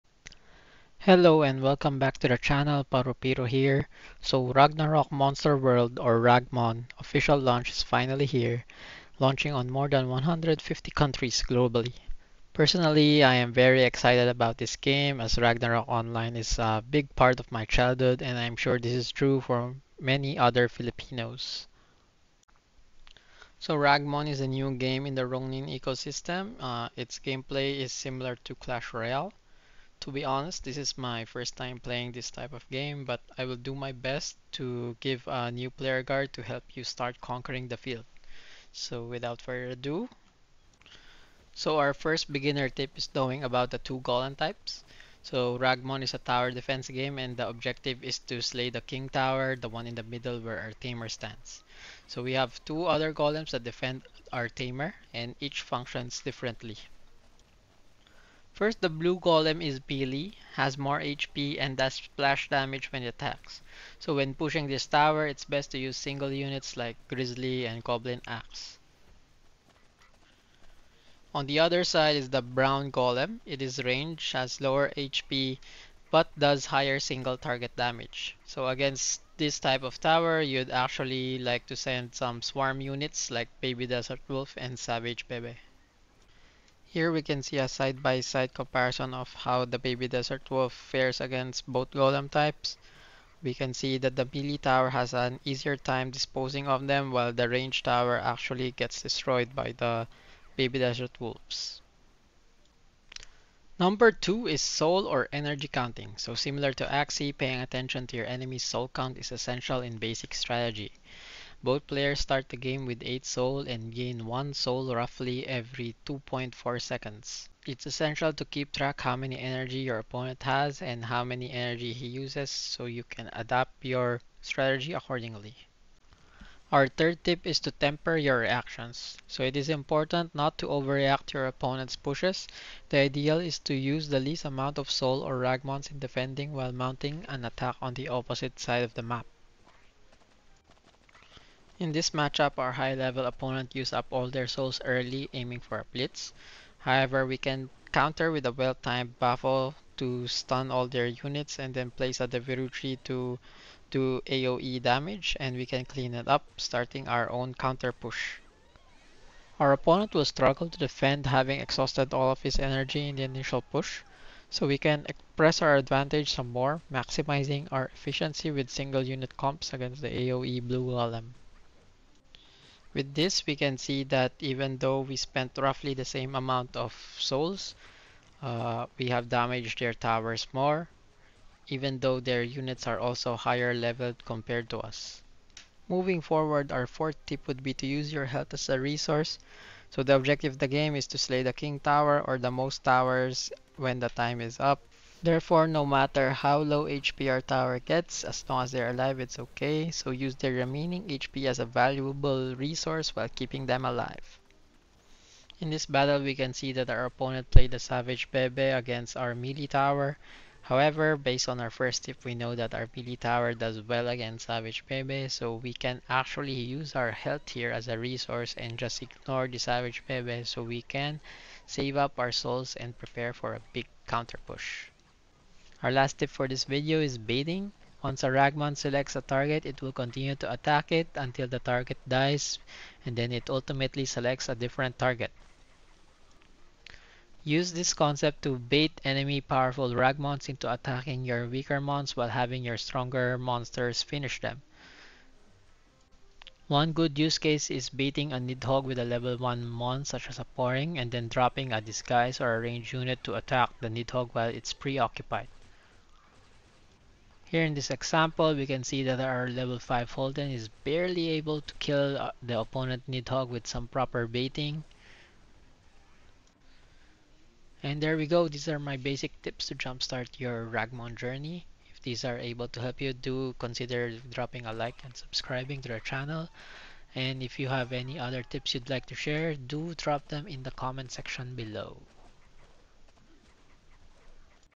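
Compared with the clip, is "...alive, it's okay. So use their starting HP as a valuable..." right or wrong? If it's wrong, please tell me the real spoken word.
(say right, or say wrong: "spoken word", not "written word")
wrong: "remaining", not "starting".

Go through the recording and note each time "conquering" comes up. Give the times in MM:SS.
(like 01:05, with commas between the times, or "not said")
00:37.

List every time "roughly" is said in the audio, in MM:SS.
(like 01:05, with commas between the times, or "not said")
01:54, 02:55.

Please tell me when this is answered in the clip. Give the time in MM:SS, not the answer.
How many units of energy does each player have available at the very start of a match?
01:53.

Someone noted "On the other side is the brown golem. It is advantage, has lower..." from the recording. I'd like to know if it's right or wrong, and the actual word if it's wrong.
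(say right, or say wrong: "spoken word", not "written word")
wrong: "range", not "advantage".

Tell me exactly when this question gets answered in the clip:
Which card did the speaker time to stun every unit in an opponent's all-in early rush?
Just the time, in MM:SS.
02:29.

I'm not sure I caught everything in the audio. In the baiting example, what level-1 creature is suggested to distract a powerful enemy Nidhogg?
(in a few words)
Poring.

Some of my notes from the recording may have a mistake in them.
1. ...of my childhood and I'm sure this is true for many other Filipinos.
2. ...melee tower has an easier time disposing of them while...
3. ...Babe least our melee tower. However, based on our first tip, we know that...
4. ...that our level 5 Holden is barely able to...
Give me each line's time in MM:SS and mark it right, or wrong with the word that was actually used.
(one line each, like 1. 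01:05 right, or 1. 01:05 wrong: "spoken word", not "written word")
1. 00:17 right
2. 01:34 right
3. 03:28 wrong: "against", not "least"
4. 04:19 right.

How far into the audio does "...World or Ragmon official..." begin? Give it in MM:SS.
00:05.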